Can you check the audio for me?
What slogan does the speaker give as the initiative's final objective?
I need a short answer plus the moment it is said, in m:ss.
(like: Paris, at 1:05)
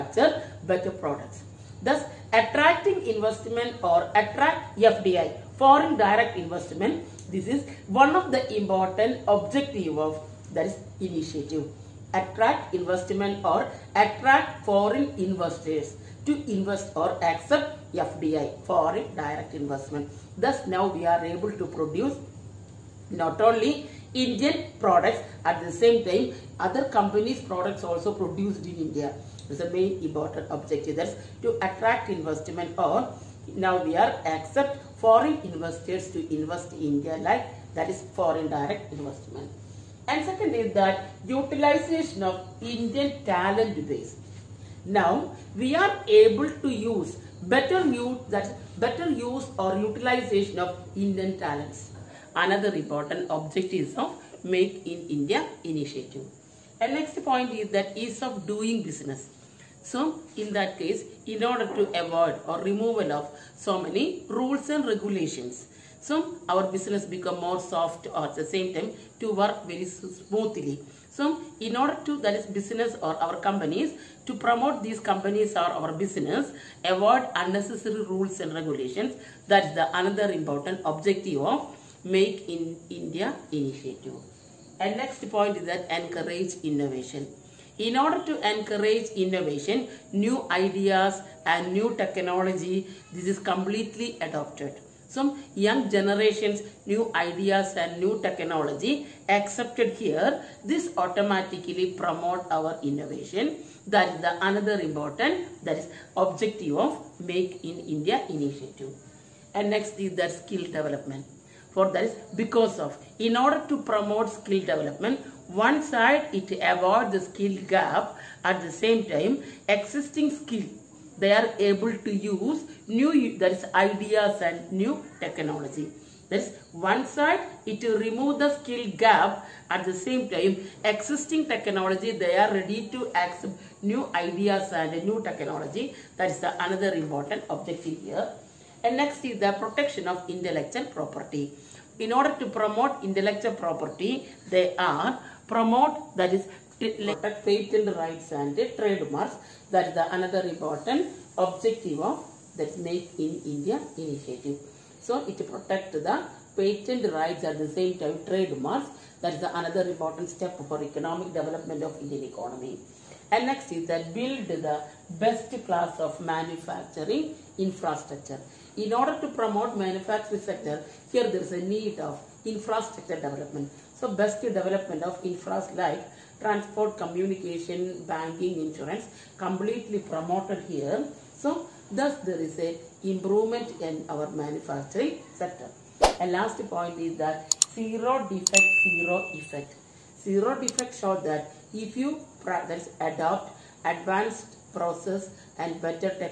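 Zero defect, zero effect, at 3:07.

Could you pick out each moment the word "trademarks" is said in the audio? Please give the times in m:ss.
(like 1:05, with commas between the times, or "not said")
2:28, 2:38.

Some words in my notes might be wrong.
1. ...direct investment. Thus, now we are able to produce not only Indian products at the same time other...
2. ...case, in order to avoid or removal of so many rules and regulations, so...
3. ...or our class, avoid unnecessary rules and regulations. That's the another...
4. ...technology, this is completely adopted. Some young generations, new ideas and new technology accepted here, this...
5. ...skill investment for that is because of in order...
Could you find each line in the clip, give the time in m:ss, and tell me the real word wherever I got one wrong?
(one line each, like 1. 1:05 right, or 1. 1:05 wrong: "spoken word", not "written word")
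1. 0:19 right
2. 1:00 right
3. 1:15 wrong: "business", not "class"
4. 1:31 right
5. 1:50 wrong: "development", not "investment".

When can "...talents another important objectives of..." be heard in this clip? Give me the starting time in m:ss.
0:51.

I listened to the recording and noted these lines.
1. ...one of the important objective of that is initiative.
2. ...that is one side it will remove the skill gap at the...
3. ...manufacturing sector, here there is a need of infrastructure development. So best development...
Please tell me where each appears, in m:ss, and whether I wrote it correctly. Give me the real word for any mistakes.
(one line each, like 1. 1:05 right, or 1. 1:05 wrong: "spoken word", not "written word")
1. 0:07 right
2. 2:06 right
3. 2:49 right.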